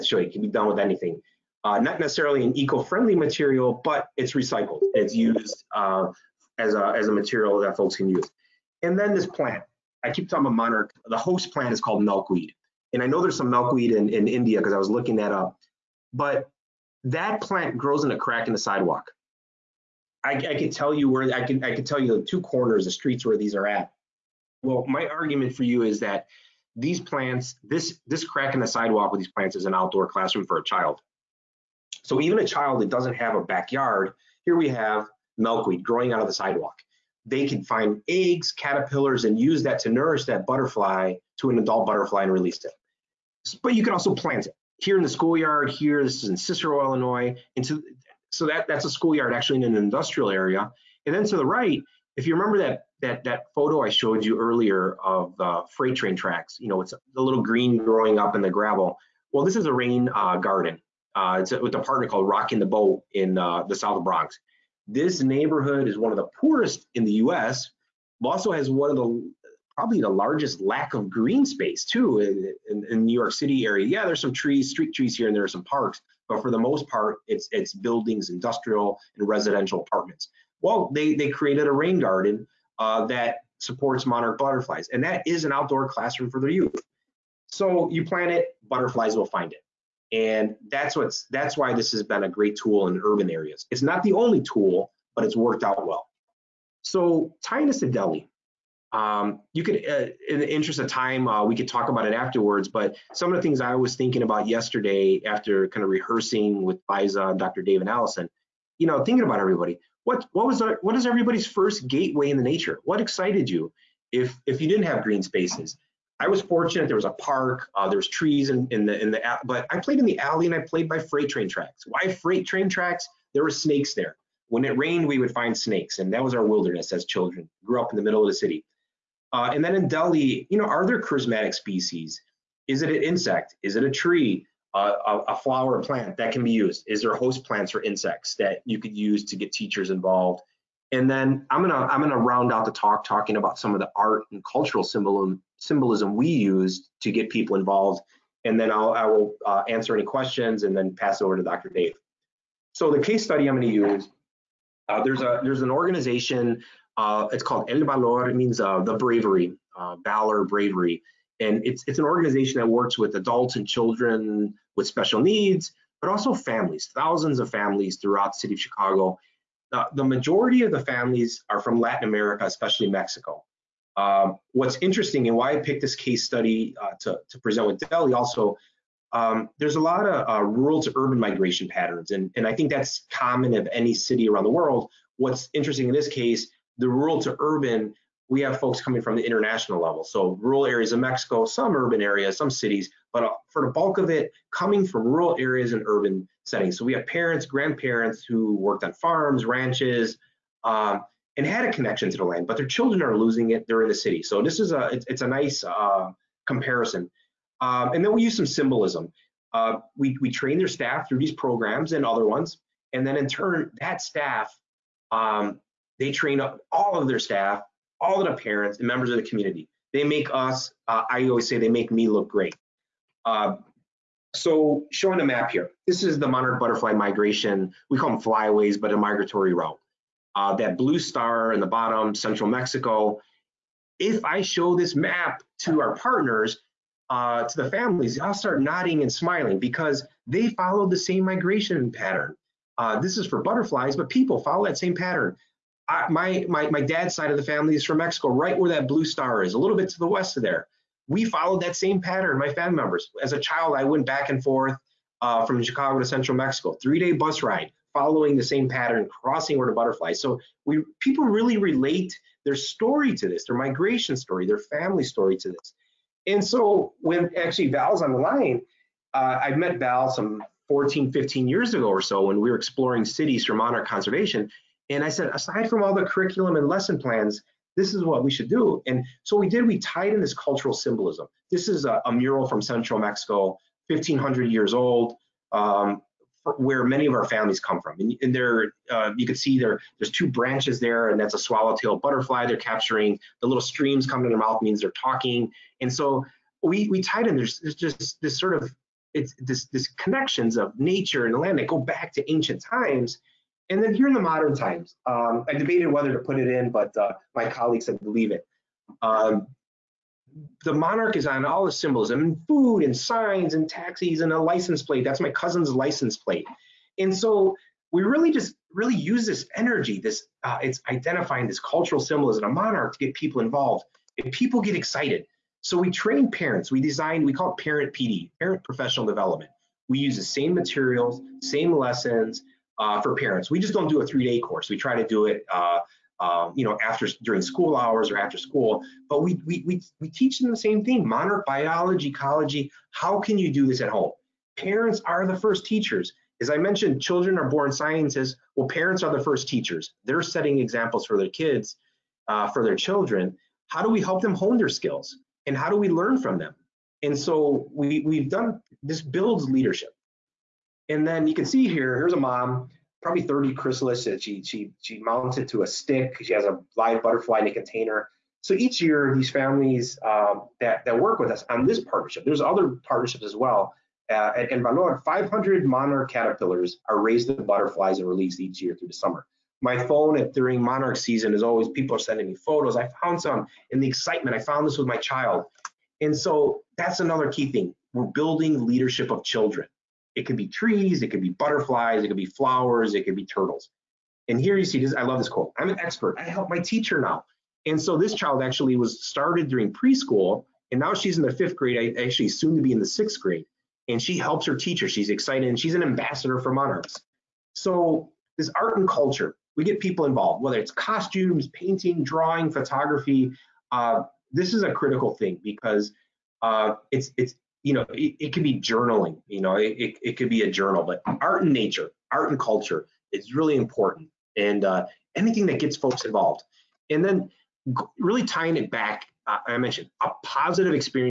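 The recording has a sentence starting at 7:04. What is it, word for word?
And uh, anything that gets folks involved.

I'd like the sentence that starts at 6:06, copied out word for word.
She has a live butterfly in a container.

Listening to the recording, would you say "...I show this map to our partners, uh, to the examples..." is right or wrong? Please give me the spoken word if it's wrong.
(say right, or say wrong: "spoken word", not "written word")
wrong: "families", not "examples".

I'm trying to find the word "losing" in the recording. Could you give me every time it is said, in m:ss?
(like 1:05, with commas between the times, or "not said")
3:23.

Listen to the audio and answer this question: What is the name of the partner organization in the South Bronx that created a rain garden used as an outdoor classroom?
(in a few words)
Rocking the Boat.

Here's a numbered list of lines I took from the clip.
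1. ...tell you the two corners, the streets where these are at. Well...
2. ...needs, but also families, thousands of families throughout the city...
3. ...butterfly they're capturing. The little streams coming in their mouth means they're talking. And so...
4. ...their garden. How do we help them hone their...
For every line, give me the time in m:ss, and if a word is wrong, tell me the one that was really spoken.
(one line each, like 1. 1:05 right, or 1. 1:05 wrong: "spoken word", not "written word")
1. 0:21 right
2. 2:45 right
3. 4:51 right
4. 5:52 wrong: "children", not "garden".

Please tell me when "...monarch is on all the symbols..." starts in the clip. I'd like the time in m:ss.
5:10.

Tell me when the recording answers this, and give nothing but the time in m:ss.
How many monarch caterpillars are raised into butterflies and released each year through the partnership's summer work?
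6:15.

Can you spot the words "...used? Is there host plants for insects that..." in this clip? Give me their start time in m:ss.
2:16.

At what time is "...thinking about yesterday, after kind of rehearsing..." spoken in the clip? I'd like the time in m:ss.
1:43.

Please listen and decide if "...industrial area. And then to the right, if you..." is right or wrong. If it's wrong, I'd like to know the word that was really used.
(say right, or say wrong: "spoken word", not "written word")
right.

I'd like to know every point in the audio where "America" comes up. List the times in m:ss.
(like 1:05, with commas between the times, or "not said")
2:52.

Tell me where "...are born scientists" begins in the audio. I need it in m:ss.
5:47.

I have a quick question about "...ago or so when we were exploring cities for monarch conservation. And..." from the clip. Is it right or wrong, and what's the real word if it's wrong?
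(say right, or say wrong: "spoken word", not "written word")
right.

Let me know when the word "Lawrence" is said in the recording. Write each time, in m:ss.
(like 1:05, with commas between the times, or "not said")
not said.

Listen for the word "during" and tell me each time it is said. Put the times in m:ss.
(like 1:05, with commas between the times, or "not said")
5:37, 6:20, 6:39.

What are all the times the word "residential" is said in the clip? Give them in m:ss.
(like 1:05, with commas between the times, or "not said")
1:19.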